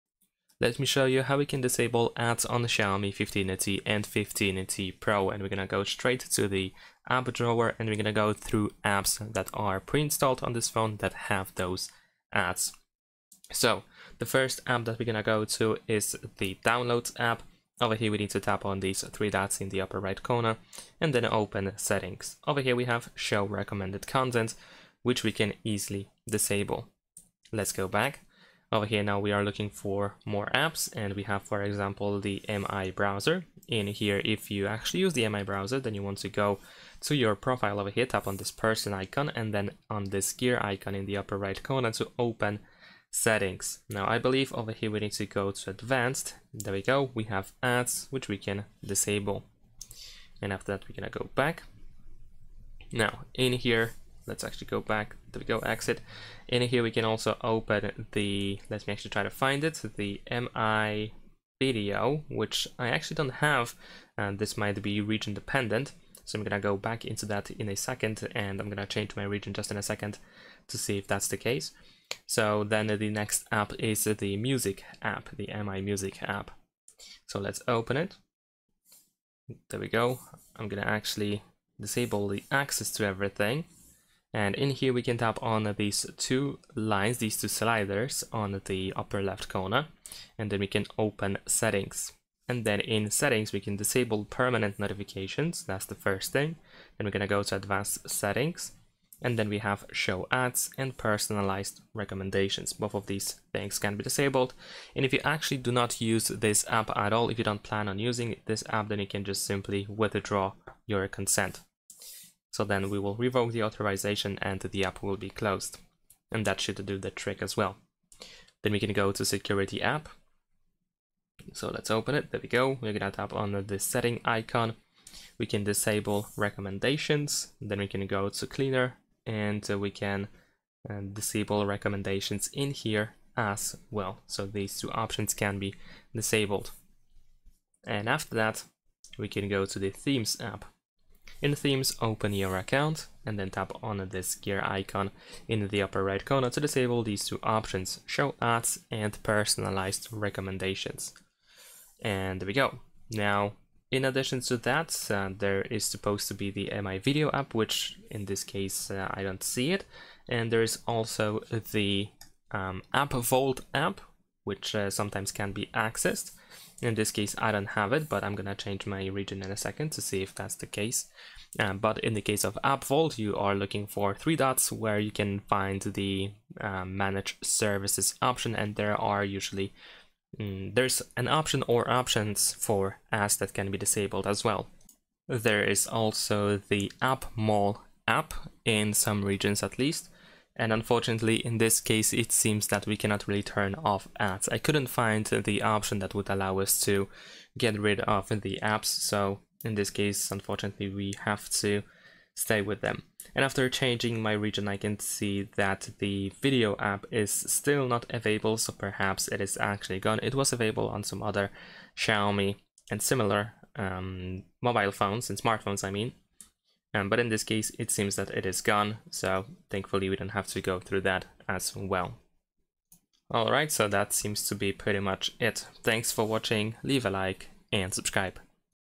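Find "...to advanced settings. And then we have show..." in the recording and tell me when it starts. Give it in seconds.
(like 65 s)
97 s.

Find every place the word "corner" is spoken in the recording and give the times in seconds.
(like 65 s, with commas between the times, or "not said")
20 s, 41 s, 89 s, 146 s.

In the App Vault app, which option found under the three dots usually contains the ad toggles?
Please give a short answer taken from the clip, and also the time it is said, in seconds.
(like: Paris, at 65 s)
Manage Services, at 176 s.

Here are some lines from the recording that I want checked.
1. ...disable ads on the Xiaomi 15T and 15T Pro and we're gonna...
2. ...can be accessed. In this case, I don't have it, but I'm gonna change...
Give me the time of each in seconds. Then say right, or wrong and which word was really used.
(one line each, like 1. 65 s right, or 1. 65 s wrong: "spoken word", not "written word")
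1. 1 s right
2. 165 s right.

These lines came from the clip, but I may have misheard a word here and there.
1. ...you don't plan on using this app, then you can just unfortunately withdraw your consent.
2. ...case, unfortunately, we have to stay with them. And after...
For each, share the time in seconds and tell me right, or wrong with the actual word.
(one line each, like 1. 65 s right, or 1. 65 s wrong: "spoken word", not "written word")
1. 107 s wrong: "simply", not "unfortunately"
2. 199 s right.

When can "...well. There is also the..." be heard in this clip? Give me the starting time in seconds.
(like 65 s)
184 s.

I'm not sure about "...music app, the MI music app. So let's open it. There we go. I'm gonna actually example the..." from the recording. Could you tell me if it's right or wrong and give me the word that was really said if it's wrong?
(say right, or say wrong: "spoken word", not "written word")
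wrong: "disable", not "example".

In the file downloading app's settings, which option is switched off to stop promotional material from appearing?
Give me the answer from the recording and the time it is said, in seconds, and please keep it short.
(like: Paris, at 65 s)
Show recommended content, at 23 s.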